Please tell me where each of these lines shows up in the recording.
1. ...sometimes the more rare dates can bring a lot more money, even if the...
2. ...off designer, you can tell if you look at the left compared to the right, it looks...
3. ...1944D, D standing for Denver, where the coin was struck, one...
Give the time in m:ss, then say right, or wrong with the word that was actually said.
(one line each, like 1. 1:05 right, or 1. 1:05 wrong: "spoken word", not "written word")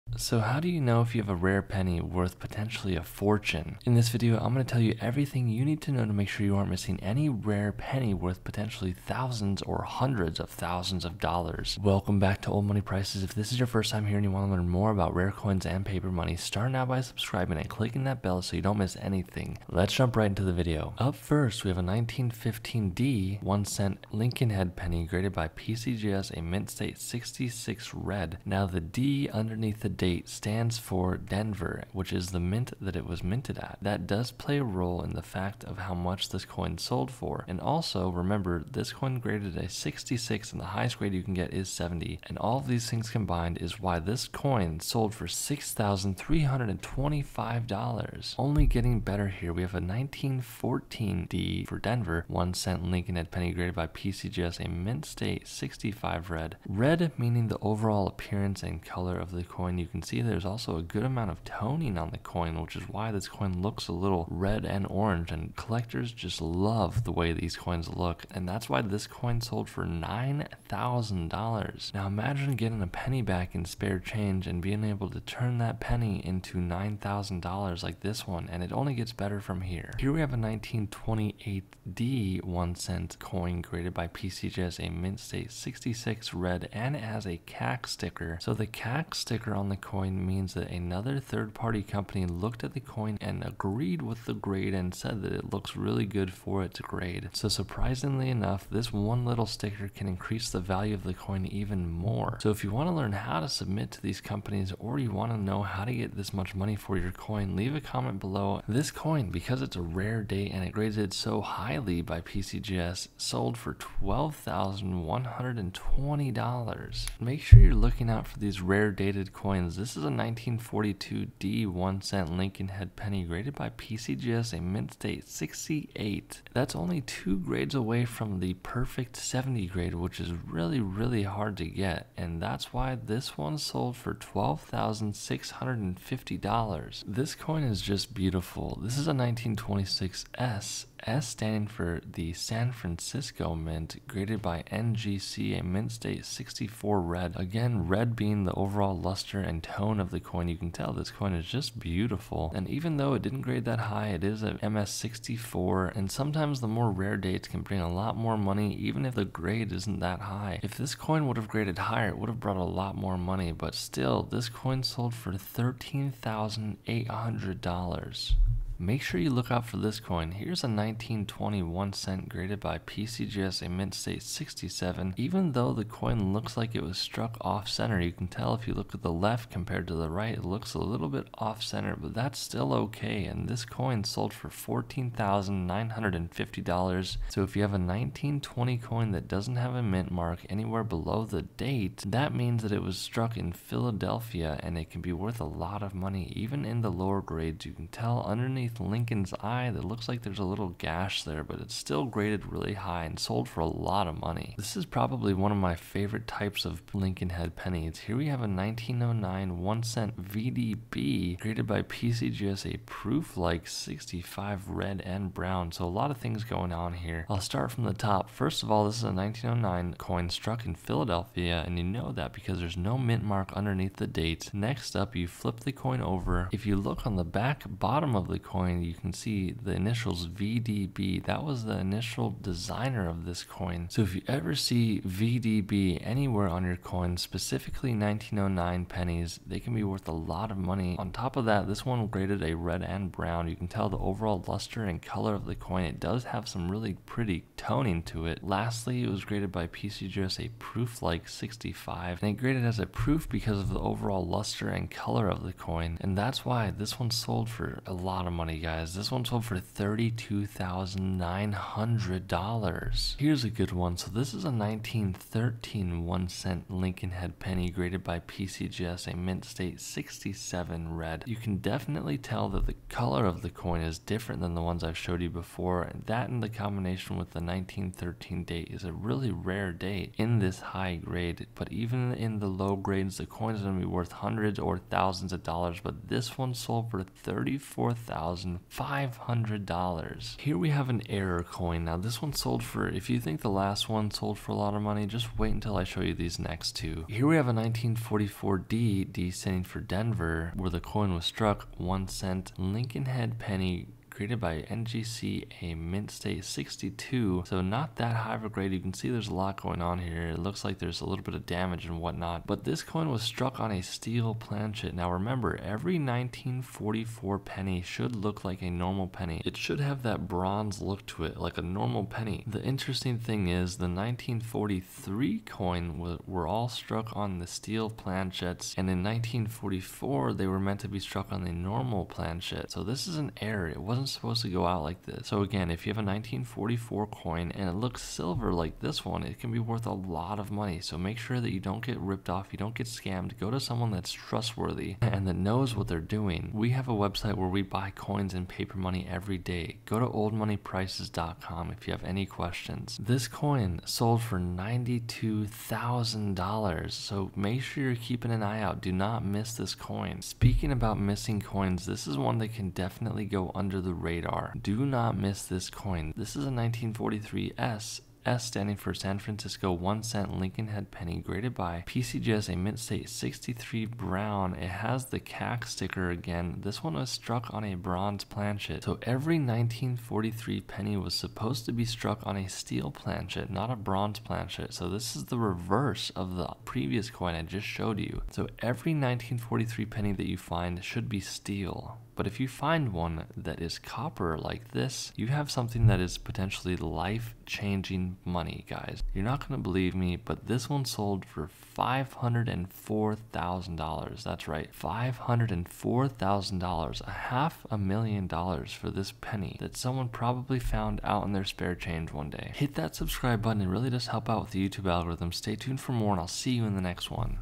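1. 2:36 right
2. 2:57 wrong: "center", not "designer"
3. 4:57 right.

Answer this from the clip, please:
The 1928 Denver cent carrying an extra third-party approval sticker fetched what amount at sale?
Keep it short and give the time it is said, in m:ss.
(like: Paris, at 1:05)
$12,120, at 1:53.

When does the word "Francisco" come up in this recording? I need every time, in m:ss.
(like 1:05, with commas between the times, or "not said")
2:22, 6:09.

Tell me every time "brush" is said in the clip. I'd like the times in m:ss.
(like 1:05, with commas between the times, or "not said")
not said.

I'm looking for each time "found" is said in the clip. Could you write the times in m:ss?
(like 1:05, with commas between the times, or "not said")
6:50.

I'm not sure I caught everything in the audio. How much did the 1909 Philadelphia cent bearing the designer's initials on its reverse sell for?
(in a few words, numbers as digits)
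$32,900.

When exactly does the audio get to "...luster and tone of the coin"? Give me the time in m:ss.
2:28.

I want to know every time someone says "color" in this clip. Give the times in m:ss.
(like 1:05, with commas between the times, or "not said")
0:58, 4:05, 4:14, 4:32.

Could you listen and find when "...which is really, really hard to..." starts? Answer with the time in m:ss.
2:09.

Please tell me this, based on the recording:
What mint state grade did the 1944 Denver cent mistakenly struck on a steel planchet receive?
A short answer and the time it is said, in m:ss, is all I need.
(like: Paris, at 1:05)
62, at 5:06.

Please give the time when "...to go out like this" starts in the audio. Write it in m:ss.
5:34.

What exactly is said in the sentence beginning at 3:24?
This is probably one of my favorite types of Lincoln head pennies.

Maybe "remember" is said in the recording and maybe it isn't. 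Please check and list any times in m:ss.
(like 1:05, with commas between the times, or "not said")
0:38, 5:15.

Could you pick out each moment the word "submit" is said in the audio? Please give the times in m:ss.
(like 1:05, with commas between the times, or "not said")
1:43.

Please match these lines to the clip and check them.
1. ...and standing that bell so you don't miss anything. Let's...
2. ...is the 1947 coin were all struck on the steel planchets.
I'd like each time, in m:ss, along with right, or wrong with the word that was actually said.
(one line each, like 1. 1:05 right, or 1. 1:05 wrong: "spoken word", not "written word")
1. 0:17 wrong: "clicking", not "standing"
2. 5:23 wrong: "1943", not "1947".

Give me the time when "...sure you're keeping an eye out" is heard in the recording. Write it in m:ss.
5:57.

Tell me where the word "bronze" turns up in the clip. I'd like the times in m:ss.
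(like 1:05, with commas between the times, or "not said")
5:20, 6:17, 6:23.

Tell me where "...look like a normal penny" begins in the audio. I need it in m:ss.
5:18.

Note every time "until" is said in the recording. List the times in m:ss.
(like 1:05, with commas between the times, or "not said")
4:55.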